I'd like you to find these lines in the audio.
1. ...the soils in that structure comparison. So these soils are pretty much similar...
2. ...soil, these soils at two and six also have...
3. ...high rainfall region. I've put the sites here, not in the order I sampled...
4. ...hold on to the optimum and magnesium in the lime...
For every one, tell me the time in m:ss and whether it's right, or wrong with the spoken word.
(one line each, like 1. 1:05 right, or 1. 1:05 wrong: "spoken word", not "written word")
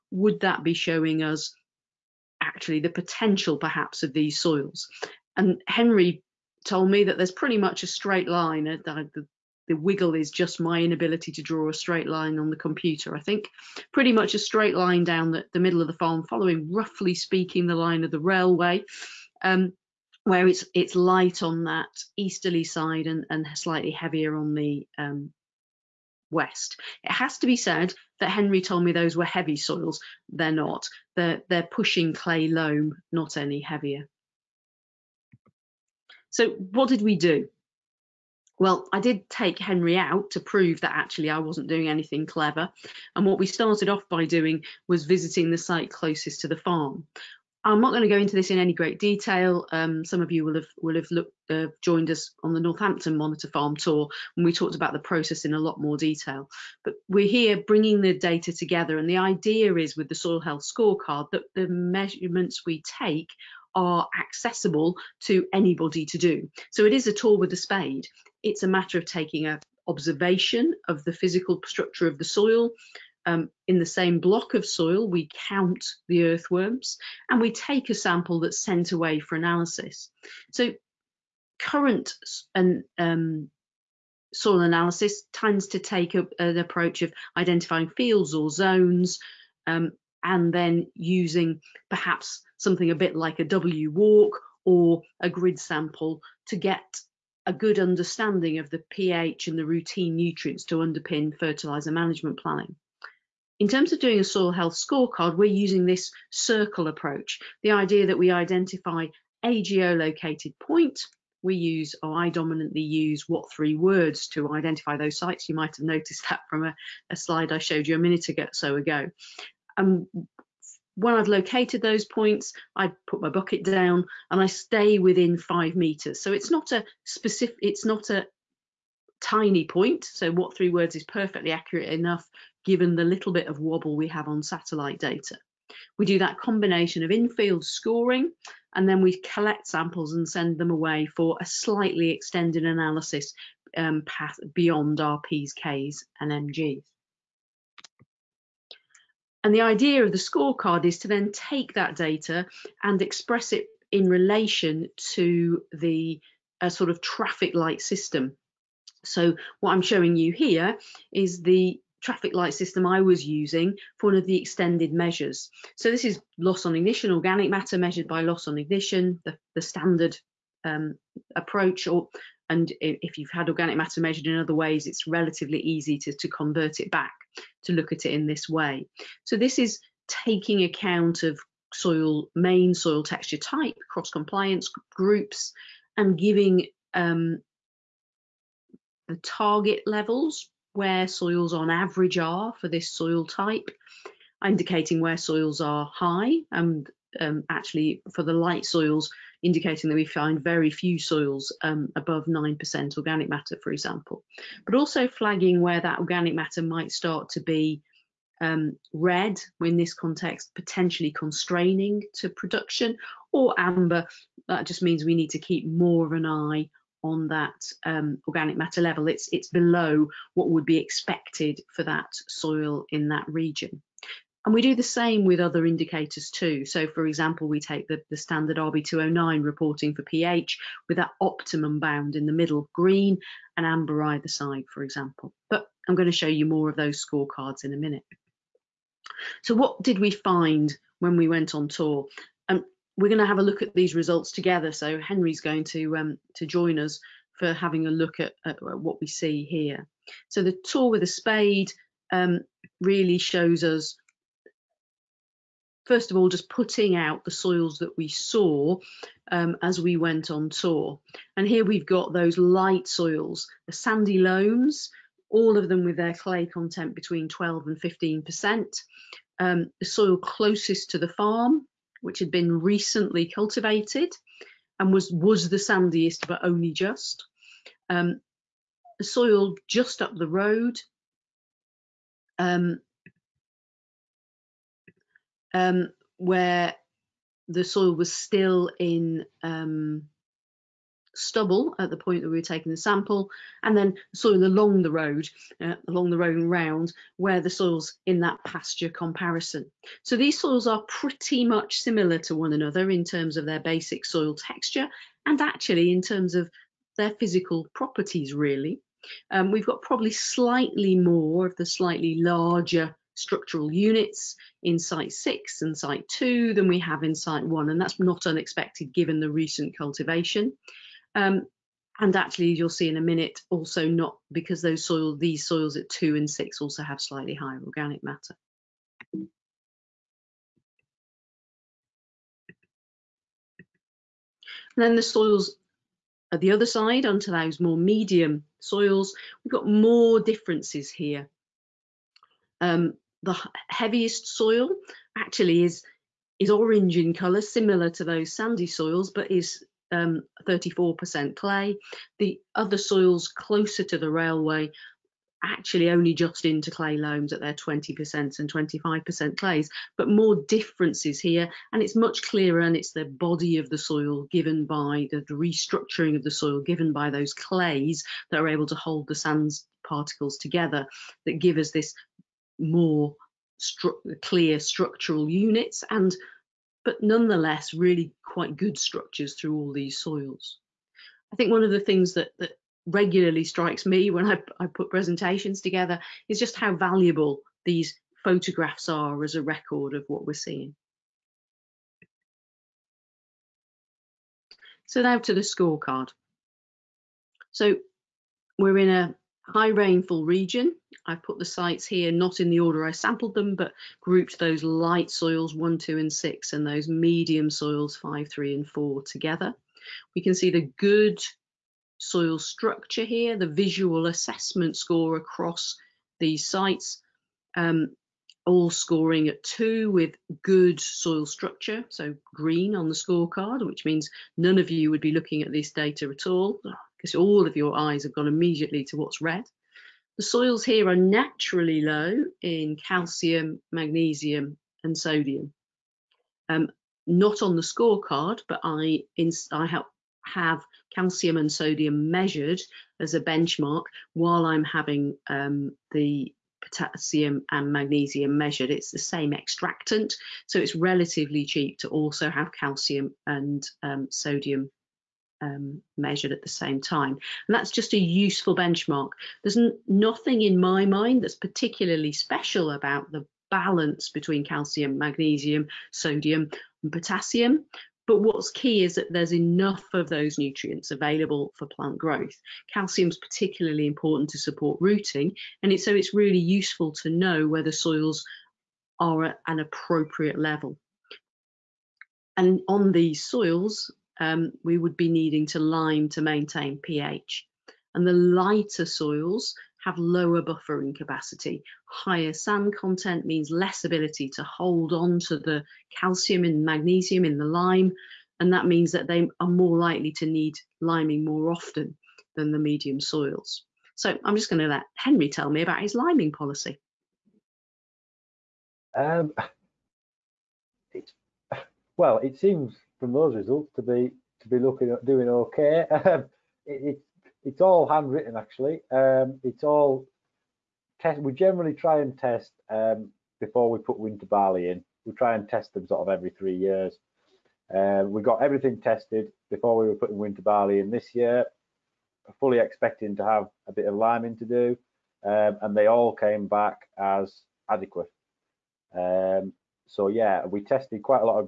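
1. 4:57 wrong: "pasture", not "structure"
2. 5:24 right
3. 6:39 right
4. 8:14 wrong: "calcium", not "optimum".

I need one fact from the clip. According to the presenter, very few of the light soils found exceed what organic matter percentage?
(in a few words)
9%.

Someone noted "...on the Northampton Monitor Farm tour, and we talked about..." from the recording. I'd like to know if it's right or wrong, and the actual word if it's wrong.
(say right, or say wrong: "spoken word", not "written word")
right.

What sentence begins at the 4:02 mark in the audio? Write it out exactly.
Um, we're going to have a look at these results together.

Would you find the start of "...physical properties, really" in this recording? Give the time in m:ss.
5:07.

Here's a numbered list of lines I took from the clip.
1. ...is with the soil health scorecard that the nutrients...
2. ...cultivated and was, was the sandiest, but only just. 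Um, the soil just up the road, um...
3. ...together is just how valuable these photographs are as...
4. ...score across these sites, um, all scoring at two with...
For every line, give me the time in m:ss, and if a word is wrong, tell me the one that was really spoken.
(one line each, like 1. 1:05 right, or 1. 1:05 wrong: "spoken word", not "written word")
1. 0:59 wrong: "measurements", not "nutrients"
2. 4:33 right
3. 6:25 right
4. 6:54 right.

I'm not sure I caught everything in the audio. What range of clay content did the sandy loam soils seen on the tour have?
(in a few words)
12 to 15%.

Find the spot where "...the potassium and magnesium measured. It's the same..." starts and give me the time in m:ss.
7:25.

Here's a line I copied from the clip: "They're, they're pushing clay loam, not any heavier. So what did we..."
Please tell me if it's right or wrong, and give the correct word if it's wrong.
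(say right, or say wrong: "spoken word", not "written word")
right.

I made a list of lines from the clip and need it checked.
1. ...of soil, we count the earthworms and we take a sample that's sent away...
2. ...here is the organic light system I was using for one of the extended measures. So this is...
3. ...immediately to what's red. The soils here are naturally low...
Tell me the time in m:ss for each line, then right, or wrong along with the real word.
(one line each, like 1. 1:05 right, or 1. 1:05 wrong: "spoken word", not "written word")
1. 1:14 right
2. 2:40 wrong: "traffic", not "organic"
3. 7:08 right.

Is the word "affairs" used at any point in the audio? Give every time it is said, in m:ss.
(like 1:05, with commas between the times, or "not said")
not said.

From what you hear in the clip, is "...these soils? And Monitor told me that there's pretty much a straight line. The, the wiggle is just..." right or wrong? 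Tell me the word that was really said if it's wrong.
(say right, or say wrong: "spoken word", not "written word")
wrong: "Henry", not "Monitor".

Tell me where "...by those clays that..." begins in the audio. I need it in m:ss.
6:06.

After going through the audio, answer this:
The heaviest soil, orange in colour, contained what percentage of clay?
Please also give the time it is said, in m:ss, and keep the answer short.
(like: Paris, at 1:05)
34%, at 5:49.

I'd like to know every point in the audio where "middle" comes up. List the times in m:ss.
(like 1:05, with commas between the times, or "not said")
0:15, 3:52.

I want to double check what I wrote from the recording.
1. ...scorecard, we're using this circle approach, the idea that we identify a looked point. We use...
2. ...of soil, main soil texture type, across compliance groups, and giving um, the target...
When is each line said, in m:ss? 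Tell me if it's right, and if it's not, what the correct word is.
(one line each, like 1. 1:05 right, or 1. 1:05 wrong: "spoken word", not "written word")
1. 1:44 wrong: "geolocated", not "looked"
2. 3:01 wrong: "cross", not "across".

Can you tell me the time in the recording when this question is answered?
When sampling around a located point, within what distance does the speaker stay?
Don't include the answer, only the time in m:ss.
2:05.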